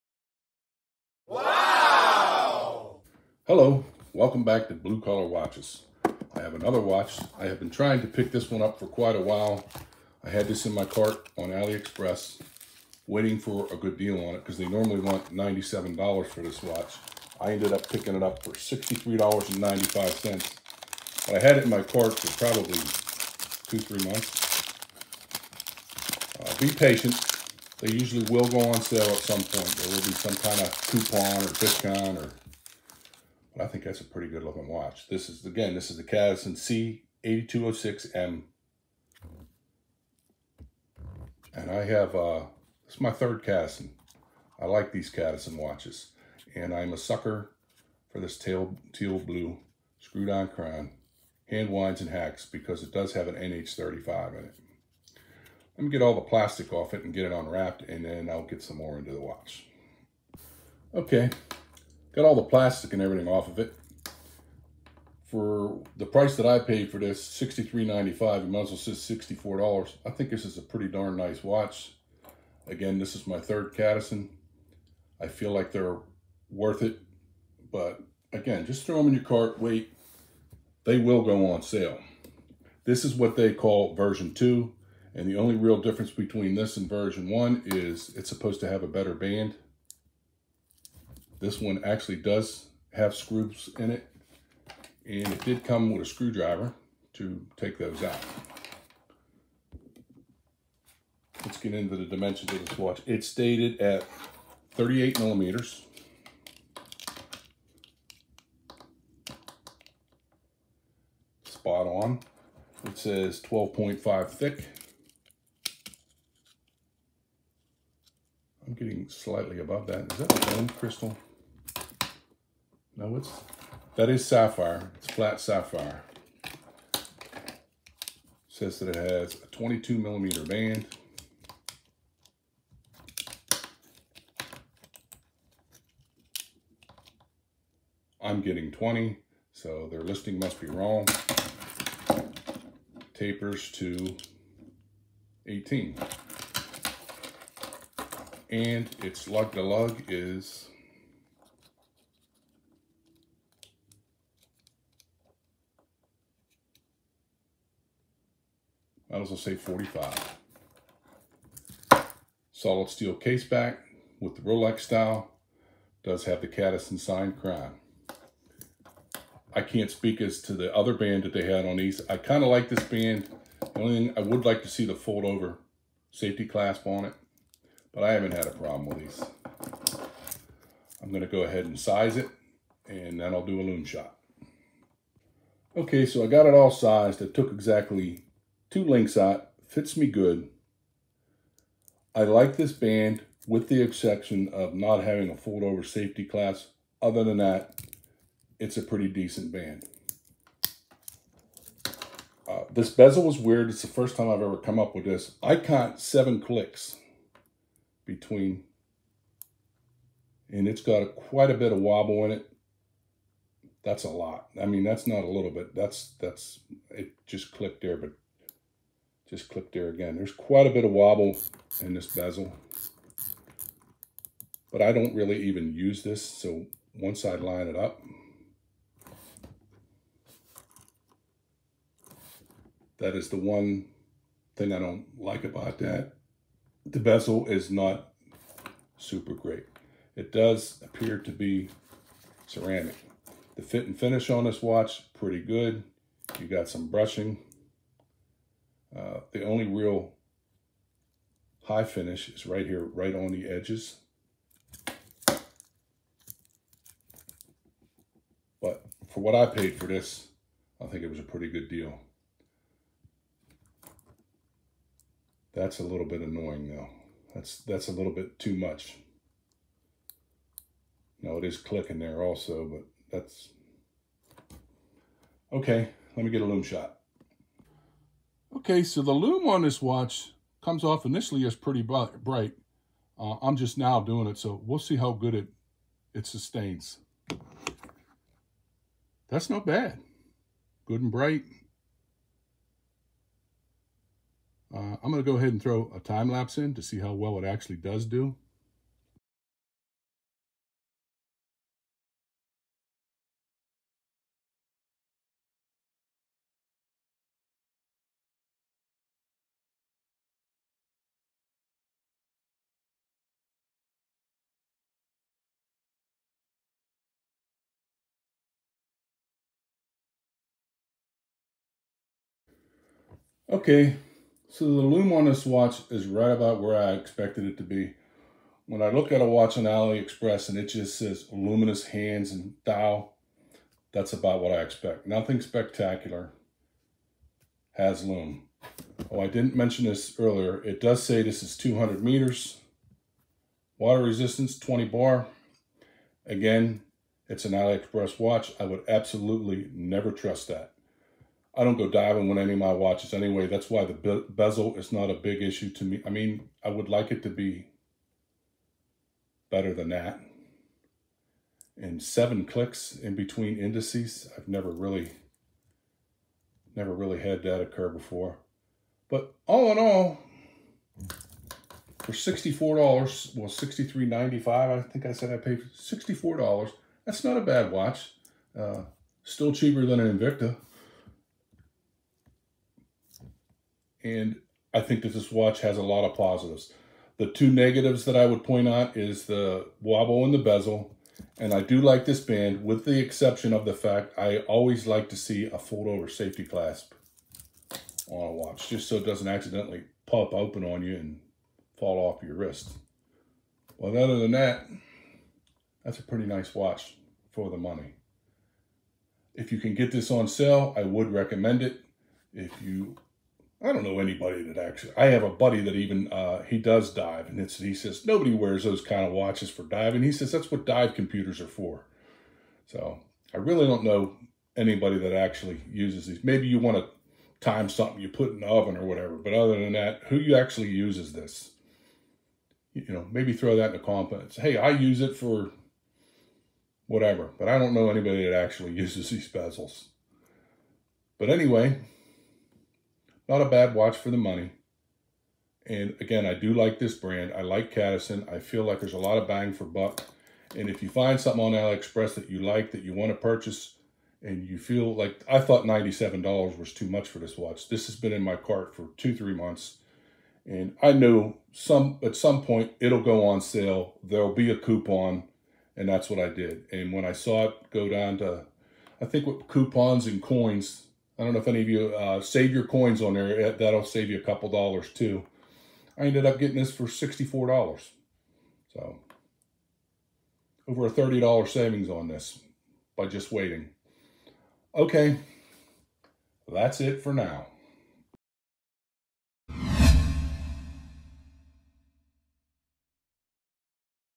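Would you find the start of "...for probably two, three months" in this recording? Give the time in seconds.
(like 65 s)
22 s.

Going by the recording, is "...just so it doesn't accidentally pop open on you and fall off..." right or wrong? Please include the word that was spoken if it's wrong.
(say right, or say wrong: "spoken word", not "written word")
right.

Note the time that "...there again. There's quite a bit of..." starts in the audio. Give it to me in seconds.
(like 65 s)
219 s.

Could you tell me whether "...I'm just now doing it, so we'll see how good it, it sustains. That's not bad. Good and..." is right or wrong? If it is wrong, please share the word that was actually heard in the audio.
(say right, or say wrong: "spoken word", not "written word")
right.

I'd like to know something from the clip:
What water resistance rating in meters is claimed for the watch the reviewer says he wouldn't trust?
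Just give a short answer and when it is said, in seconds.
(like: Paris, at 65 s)
200 meters, at 341 s.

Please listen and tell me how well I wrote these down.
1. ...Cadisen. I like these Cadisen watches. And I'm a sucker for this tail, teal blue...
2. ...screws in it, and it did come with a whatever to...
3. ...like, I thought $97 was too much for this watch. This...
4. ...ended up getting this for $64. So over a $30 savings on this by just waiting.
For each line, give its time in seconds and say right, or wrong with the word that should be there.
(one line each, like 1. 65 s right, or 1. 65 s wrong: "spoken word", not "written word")
1. 43 s right
2. 93 s wrong: "screwdriver", not "whatever"
3. 454 s right
4. 476 s right.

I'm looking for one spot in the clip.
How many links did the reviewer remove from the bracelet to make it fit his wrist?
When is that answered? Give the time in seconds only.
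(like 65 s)
188 s.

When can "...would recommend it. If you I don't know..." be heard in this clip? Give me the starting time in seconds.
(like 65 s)
410 s.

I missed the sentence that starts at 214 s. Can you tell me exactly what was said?
I mean, that's not a little bit.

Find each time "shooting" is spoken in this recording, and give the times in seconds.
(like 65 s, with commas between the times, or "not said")
not said.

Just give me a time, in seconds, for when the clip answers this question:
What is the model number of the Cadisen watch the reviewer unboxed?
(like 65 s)
37 s.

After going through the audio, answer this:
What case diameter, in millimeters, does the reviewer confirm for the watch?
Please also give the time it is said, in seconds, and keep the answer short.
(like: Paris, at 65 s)
38 millimeters, at 104 s.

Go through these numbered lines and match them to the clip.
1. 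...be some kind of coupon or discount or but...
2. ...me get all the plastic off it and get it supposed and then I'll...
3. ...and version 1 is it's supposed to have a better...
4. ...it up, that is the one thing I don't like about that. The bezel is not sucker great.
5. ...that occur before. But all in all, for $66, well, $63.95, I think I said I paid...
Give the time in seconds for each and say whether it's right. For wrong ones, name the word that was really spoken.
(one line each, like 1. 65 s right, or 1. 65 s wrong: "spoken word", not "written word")
1. 29 s right
2. 55 s wrong: "unwrapped", not "supposed"
3. 86 s right
4. 227 s wrong: "super", not "sucker"
5. 367 s wrong: "64", not "66".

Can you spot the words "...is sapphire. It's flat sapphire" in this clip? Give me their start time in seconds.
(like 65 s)
124 s.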